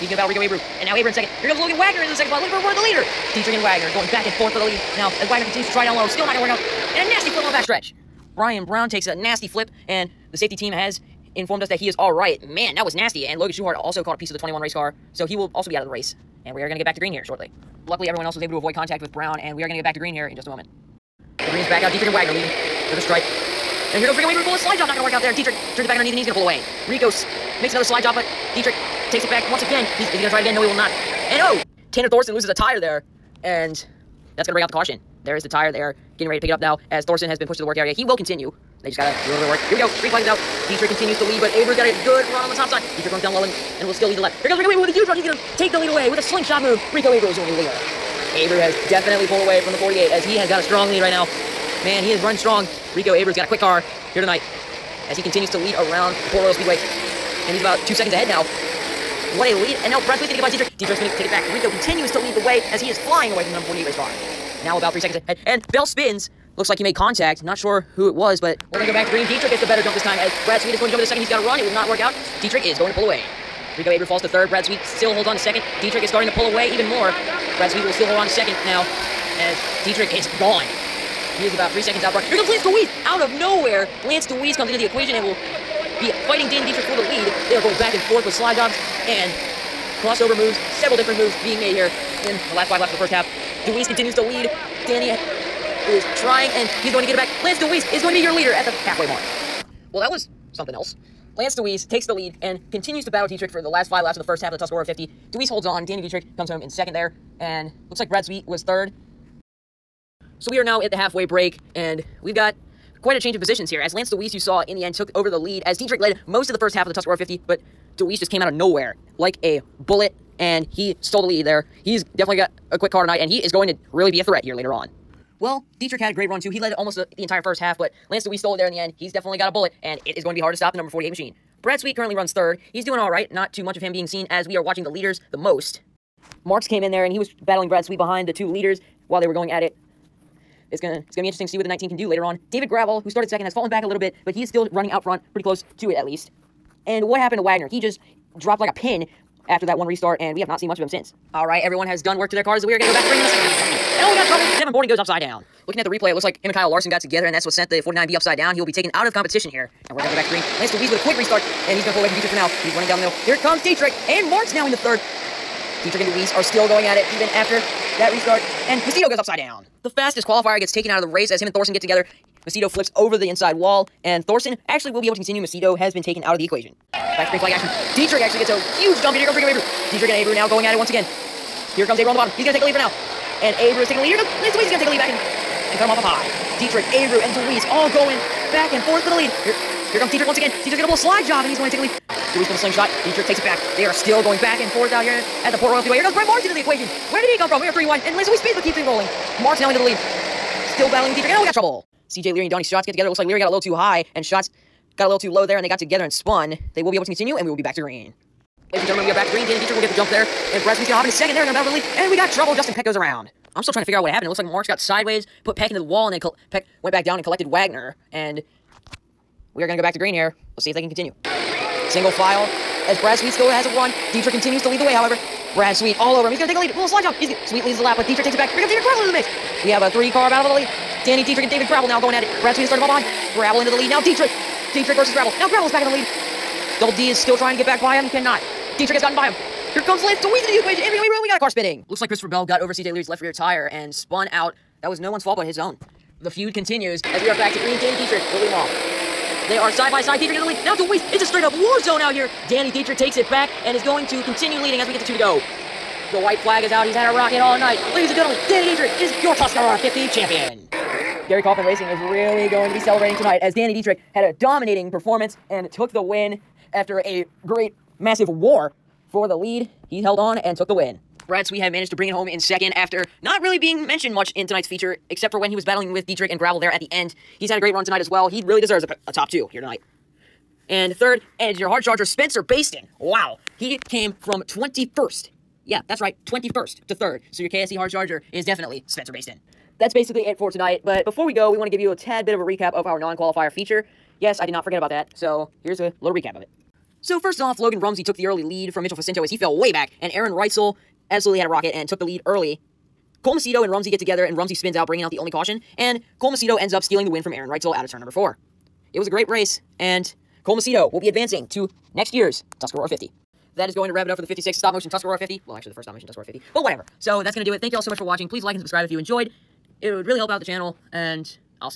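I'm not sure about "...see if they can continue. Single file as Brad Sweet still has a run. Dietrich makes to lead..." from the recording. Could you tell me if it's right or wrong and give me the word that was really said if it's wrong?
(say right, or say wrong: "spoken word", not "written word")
wrong: "continues", not "makes".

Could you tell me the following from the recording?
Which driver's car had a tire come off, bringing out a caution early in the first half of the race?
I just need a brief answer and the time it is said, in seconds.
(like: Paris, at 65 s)
Tanner Thorson, at 31 s.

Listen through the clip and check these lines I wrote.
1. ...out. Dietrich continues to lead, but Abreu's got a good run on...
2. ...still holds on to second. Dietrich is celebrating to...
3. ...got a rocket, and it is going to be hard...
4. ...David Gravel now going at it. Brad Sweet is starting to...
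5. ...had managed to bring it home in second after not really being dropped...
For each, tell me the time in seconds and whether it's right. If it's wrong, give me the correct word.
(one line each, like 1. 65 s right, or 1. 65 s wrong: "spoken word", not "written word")
1. 40 s right
2. 74 s wrong: "starting", not "celebrating"
3. 129 s wrong: "bullet", not "rocket"
4. 231 s right
5. 271 s wrong: "mentioned", not "dropped".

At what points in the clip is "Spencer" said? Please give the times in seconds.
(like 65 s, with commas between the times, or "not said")
282 s, 288 s.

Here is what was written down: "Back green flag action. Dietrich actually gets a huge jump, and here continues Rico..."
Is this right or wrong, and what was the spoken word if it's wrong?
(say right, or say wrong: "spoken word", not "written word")
wrong: "comes", not "continues".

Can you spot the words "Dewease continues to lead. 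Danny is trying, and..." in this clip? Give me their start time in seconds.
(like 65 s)
93 s.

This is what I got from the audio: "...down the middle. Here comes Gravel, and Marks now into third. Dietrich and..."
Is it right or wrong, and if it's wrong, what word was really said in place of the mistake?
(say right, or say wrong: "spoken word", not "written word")
wrong: "Dietrich", not "Gravel".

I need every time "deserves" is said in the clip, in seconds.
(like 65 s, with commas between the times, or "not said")
278 s.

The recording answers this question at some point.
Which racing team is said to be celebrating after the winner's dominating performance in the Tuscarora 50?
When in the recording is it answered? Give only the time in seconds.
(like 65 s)
261 s.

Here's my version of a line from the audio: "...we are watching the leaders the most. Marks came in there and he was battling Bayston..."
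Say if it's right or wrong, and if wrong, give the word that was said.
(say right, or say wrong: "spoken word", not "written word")
wrong: "Brad", not "Bayston".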